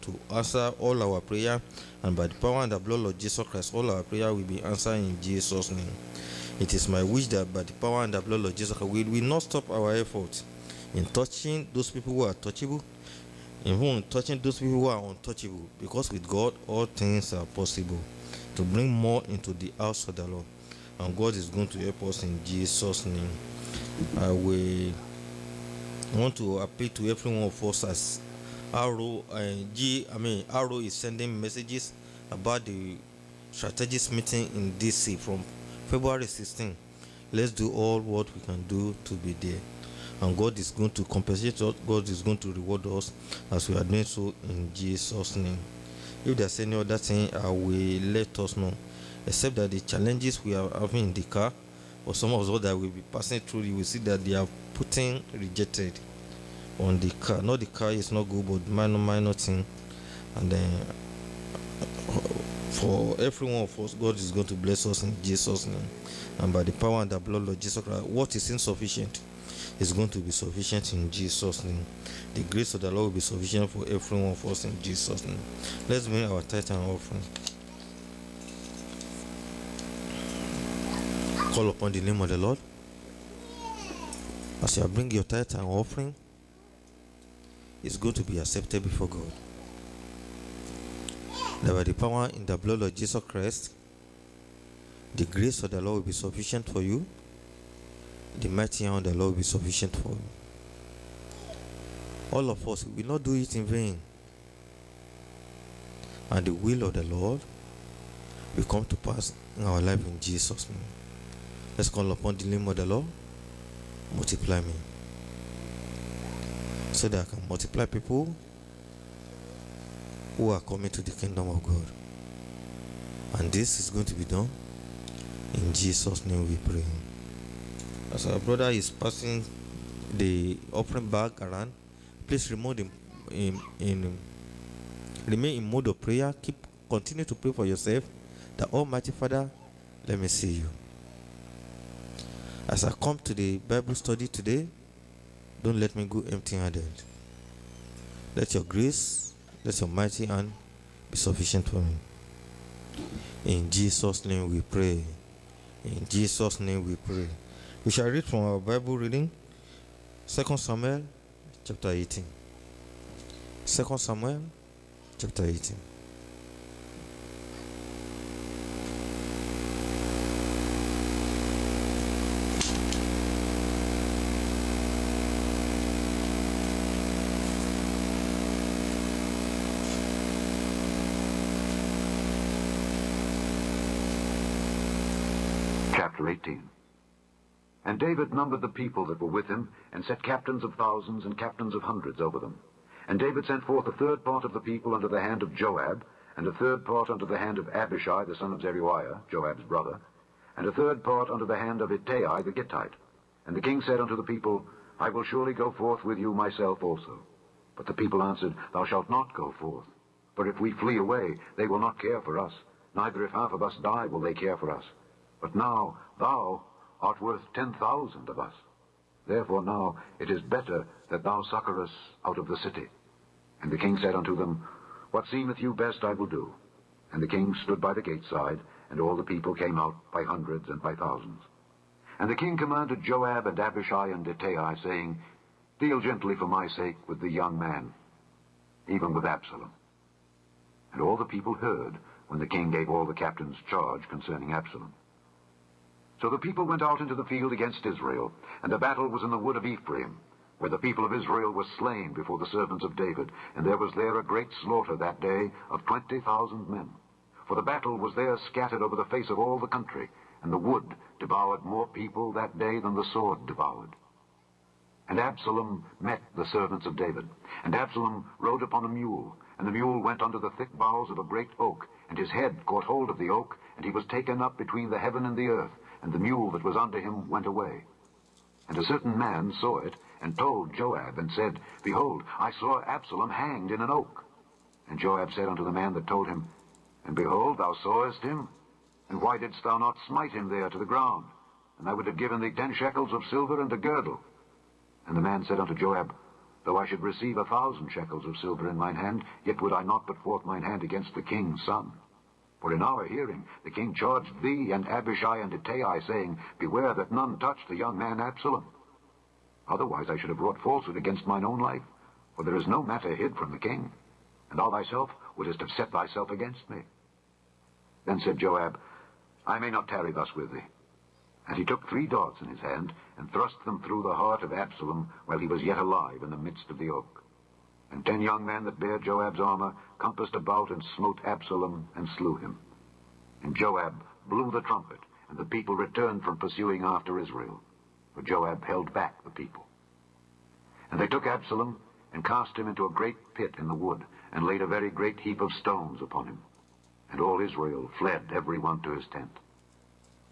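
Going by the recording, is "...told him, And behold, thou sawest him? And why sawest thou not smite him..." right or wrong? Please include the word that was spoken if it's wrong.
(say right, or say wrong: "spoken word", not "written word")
wrong: "didst", not "sawest".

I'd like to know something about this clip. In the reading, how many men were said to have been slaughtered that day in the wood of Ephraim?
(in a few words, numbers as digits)
20,000.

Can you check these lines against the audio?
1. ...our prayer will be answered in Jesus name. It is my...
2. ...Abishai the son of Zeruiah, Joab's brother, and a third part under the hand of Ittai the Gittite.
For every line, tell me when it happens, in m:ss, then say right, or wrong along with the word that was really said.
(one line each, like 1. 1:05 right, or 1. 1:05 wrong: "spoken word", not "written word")
1. 0:03 right
2. 3:17 right.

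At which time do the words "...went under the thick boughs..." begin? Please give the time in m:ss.
4:29.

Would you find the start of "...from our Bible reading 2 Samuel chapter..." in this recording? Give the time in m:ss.
2:38.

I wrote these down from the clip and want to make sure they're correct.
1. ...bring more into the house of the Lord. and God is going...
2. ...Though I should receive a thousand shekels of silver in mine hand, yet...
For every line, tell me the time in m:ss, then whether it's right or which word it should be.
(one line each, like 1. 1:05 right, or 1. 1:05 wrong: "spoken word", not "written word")
1. 0:18 right
2. 4:56 right.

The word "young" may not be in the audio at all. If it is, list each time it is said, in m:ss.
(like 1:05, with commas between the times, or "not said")
3:57, 5:07, 5:28.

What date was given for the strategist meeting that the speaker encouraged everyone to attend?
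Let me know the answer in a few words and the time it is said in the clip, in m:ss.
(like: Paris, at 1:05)
February 16, at 0:35.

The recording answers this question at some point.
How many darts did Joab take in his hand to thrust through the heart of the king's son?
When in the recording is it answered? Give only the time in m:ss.
5:21.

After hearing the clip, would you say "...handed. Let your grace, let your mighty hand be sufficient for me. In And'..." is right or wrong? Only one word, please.
wrong.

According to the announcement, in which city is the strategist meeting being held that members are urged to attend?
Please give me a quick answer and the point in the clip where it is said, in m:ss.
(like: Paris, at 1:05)
DC, at 0:34.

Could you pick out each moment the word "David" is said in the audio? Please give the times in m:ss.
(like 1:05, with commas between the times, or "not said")
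3:13, 4:12, 4:26.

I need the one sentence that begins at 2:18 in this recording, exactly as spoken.
The Almighty Father, let me see you.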